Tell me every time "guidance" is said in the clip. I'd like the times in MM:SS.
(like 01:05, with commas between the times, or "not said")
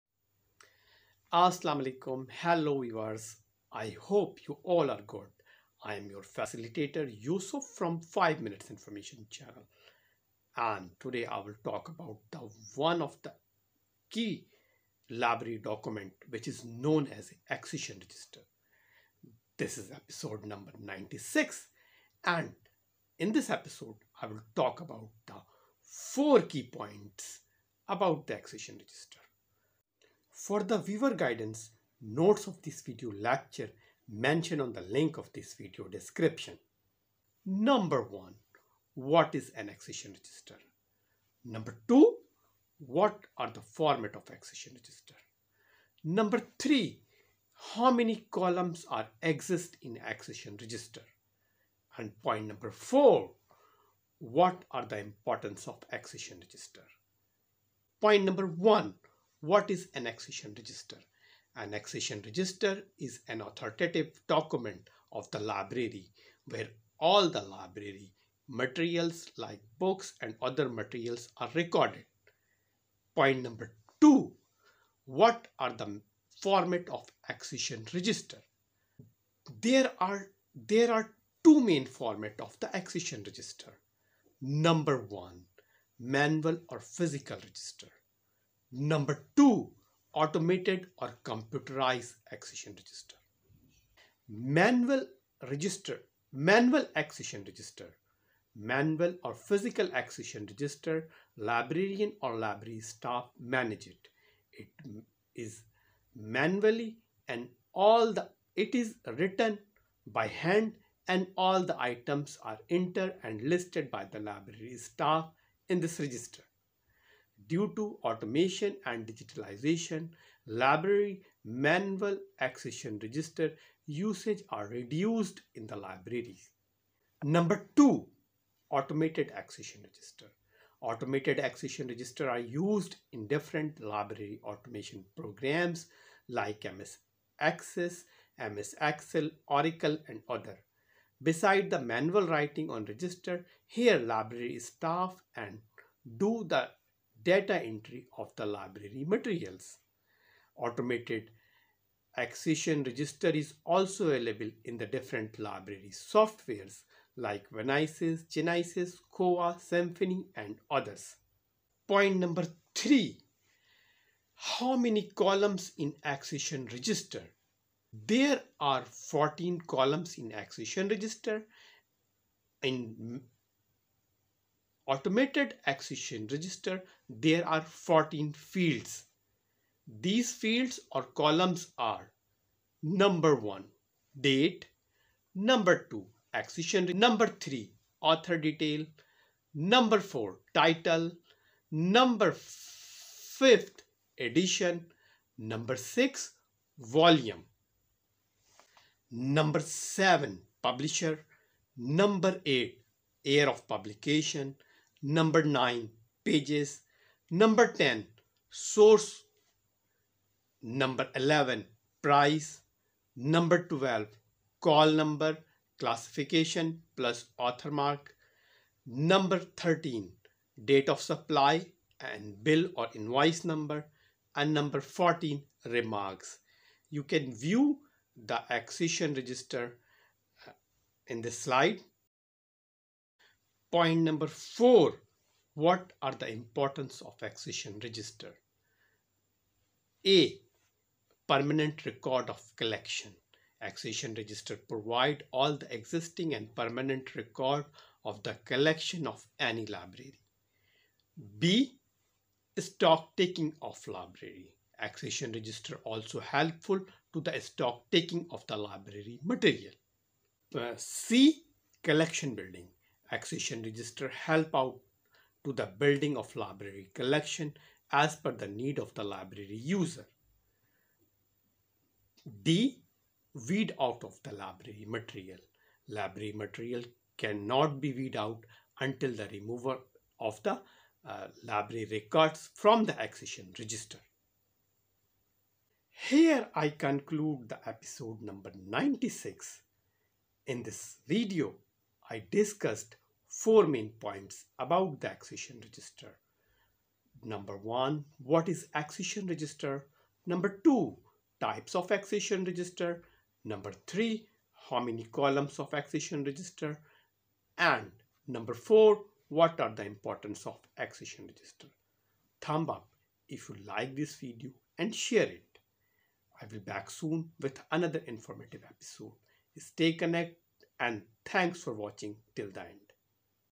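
00:31.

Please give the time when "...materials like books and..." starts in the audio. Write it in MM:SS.
01:08.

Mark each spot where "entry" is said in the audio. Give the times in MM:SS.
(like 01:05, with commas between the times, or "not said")
02:27.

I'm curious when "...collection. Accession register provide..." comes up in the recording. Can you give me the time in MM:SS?
04:02.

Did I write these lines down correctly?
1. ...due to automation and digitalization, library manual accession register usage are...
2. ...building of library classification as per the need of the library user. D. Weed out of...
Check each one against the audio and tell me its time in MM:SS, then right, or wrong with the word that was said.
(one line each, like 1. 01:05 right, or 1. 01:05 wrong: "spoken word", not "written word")
1. 01:57 right
2. 04:25 wrong: "collection", not "classification".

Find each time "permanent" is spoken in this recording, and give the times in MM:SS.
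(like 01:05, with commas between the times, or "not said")
04:01, 04:06.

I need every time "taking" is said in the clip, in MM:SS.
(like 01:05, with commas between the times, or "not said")
04:13, 04:17.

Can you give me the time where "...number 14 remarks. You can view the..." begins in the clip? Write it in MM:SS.
03:44.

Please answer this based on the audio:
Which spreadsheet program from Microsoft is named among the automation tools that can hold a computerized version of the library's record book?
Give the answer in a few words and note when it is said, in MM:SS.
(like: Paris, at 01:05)
MS Excel, at 02:18.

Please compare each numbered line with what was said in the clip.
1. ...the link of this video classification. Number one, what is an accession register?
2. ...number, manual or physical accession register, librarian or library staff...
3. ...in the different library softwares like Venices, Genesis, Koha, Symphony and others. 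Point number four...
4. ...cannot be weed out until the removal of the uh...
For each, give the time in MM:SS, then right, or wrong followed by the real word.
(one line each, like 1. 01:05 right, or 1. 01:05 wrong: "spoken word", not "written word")
1. 00:34 wrong: "description", not "classification"
2. 01:37 wrong: "register", not "number"
3. 02:34 wrong: "three", not "four"
4. 04:37 right.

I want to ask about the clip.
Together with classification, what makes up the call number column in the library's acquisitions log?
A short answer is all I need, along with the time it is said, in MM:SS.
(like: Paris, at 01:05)
author mark, at 03:37.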